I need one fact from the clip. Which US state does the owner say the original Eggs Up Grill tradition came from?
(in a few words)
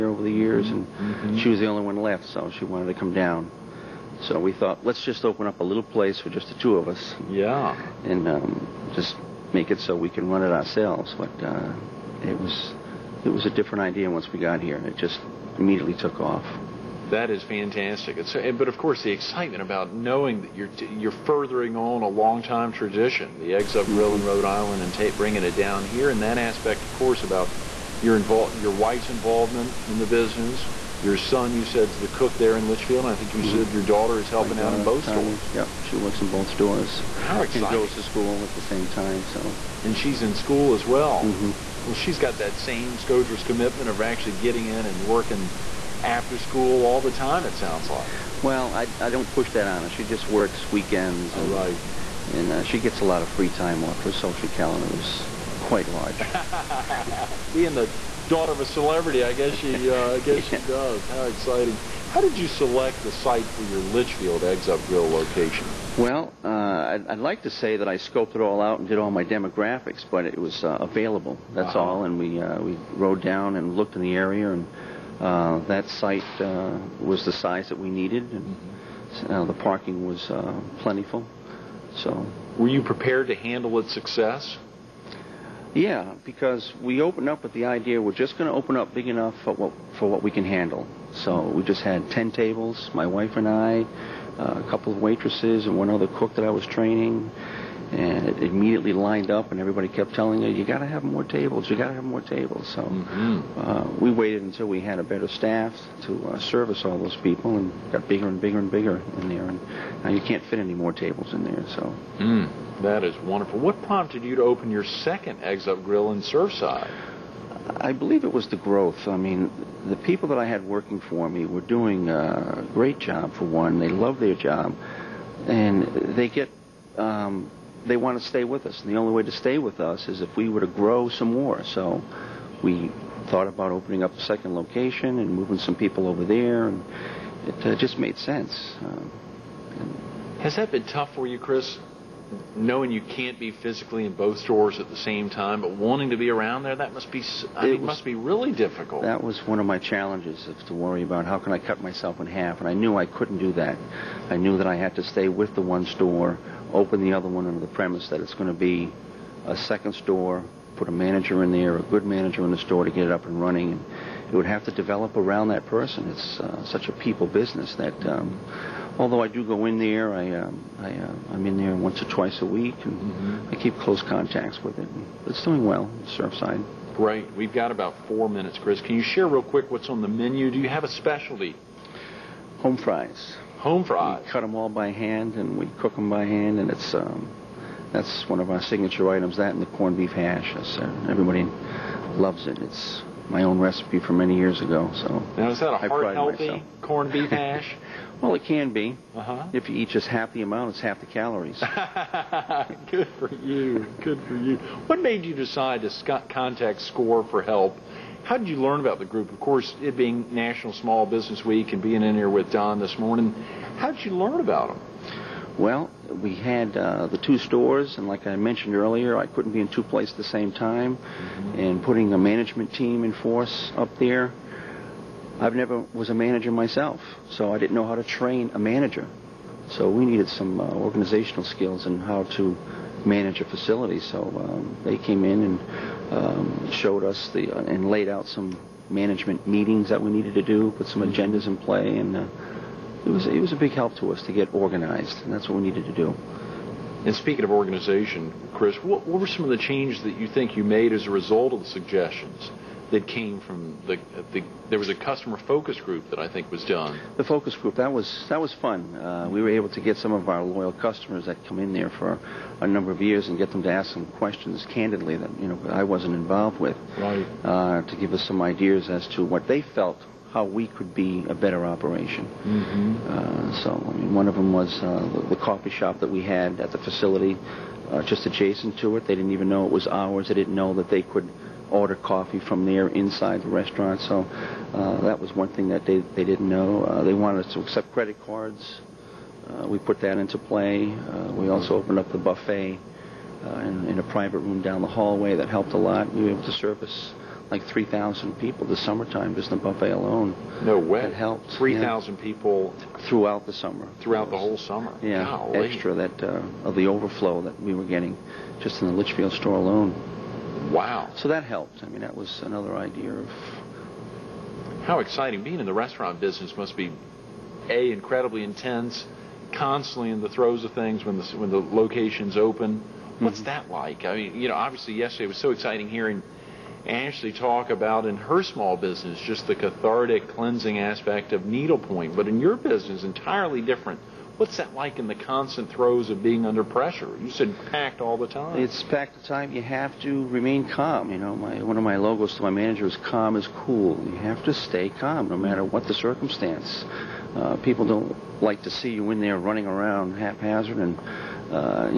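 Rhode Island.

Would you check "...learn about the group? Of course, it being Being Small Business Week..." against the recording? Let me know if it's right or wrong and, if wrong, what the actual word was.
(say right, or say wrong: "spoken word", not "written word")
wrong: "National", not "Being".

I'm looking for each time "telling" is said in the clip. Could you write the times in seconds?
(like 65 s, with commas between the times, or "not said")
100 s.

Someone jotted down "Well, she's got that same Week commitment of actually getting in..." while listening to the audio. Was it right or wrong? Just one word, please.
wrong.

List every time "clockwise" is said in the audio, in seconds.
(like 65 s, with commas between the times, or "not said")
not said.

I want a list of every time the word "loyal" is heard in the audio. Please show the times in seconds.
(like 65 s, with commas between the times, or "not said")
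260 s.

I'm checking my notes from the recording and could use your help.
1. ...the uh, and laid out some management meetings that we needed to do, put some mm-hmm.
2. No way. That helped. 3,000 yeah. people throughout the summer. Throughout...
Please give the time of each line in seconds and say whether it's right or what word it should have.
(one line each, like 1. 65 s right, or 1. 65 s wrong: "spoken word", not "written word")
1. 237 s right
2. 300 s right.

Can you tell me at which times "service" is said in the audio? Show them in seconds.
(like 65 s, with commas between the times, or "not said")
106 s, 296 s.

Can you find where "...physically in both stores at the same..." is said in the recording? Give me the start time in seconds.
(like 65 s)
143 s.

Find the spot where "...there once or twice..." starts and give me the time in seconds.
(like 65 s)
171 s.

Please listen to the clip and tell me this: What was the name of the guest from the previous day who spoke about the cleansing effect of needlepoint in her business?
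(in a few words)
Ashley.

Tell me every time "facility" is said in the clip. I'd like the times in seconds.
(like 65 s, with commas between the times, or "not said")
233 s, 276 s.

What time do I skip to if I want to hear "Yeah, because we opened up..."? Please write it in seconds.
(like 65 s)
85 s.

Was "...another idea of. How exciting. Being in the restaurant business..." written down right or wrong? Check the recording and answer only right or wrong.
right.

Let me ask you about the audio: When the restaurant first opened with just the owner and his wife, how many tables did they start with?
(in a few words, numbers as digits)
10.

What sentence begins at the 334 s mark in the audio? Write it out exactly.
What's that like in the constant throes of being under pressure?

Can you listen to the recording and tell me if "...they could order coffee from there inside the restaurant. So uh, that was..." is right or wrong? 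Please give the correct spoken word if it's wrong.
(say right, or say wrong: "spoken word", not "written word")
right.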